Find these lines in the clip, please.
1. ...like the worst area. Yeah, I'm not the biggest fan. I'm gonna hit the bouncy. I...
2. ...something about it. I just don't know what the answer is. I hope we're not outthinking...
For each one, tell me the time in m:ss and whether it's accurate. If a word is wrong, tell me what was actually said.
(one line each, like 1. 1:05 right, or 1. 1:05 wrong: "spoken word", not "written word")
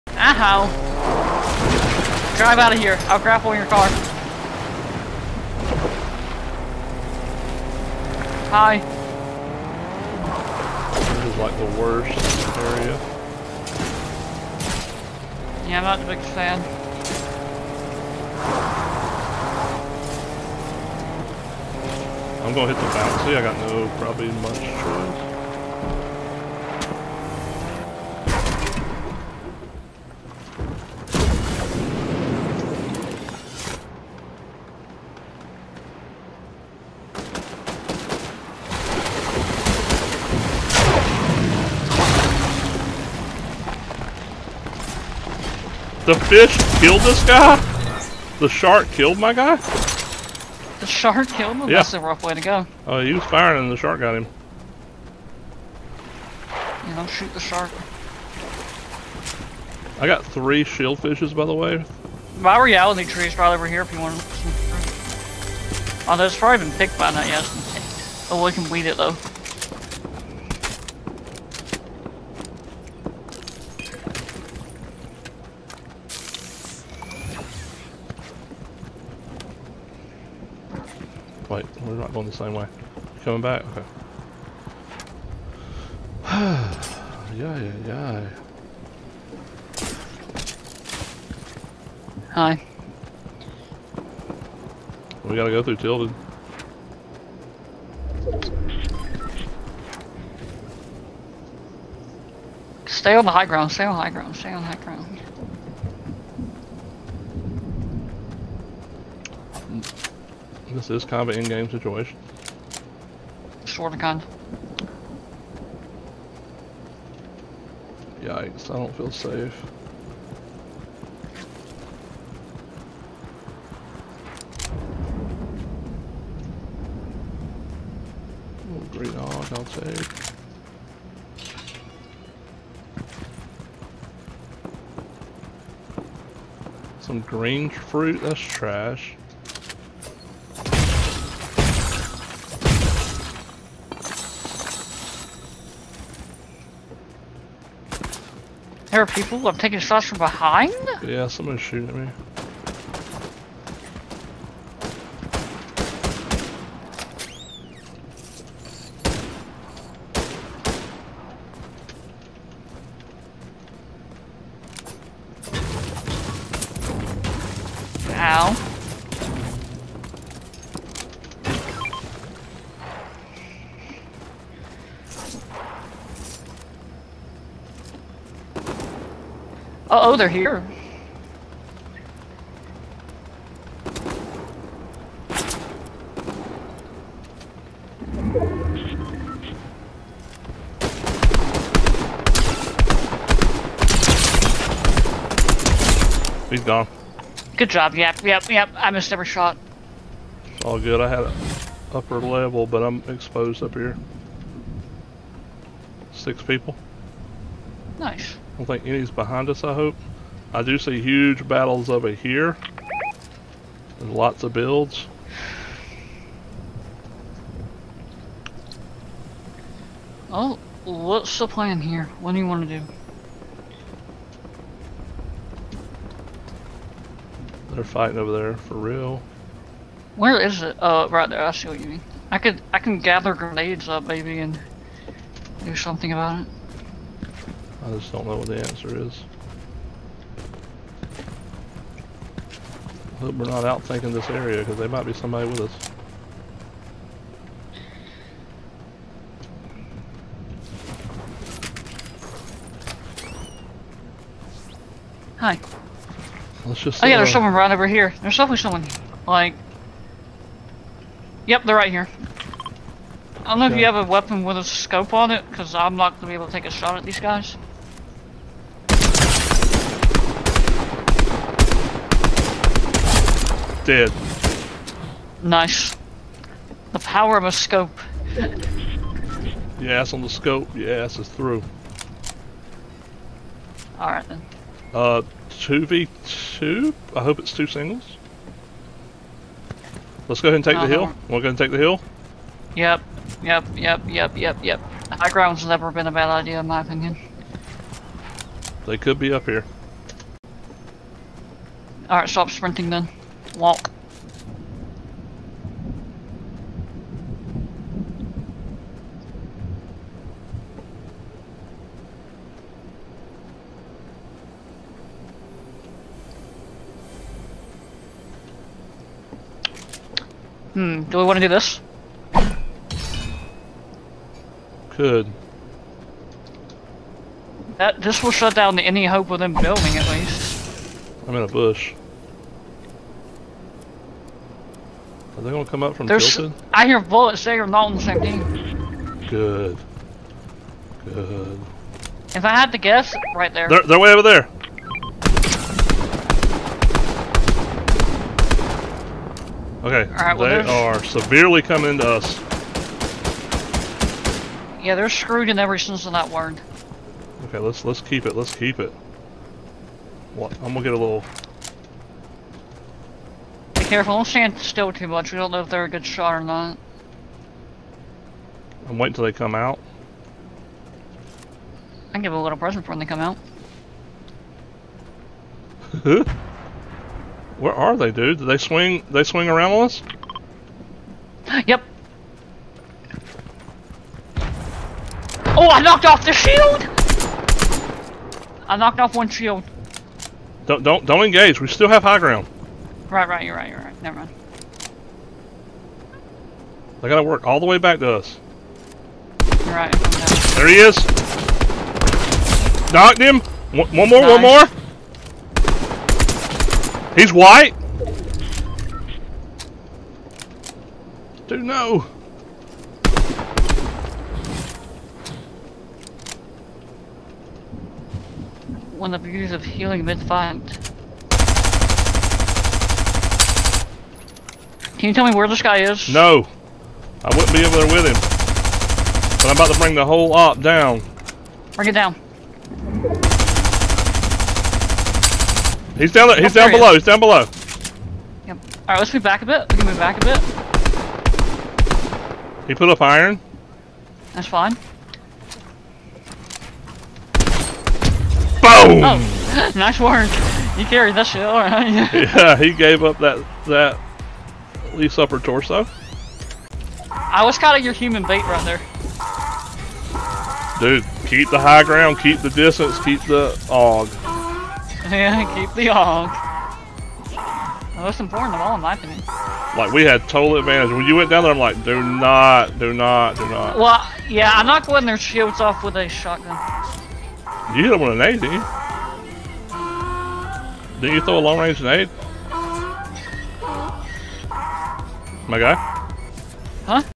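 1. 0:11 right
2. 3:55 right.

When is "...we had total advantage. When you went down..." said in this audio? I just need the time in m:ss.
7:49.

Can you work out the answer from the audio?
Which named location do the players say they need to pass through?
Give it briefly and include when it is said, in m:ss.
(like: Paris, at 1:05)
Tilden, at 1:35.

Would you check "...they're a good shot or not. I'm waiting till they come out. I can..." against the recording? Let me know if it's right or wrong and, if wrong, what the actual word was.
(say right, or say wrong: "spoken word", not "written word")
right.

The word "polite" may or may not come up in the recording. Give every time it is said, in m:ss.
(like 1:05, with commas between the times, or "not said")
not said.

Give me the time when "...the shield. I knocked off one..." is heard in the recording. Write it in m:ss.
6:26.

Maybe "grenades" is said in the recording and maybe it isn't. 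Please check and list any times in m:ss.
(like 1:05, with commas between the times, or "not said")
3:53.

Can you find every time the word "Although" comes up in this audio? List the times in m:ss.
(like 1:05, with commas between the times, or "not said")
1:06.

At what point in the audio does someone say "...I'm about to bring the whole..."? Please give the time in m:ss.
7:09.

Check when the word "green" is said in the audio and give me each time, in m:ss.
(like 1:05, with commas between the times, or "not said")
2:08, 2:17.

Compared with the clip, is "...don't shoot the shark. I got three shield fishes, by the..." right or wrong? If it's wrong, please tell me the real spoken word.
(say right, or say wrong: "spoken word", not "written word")
right.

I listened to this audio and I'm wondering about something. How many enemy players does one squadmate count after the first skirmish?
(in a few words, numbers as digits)
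6.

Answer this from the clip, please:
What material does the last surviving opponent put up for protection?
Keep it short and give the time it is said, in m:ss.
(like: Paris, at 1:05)
Iron, at 7:23.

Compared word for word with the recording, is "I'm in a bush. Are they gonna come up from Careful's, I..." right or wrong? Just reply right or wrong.
wrong.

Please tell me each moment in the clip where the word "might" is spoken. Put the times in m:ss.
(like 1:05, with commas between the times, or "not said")
4:04.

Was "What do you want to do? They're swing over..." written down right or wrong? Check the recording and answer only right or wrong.
wrong.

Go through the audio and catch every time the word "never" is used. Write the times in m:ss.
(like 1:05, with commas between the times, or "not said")
4:55, 6:34.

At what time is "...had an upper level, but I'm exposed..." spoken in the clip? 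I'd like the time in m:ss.
3:21.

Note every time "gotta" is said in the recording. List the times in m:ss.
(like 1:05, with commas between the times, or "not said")
1:35, 6:37.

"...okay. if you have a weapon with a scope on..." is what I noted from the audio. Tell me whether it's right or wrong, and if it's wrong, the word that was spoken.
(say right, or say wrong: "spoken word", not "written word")
right.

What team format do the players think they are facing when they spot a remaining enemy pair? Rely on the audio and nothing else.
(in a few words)
2v2.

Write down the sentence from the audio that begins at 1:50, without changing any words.
This is kind of an in-game situation.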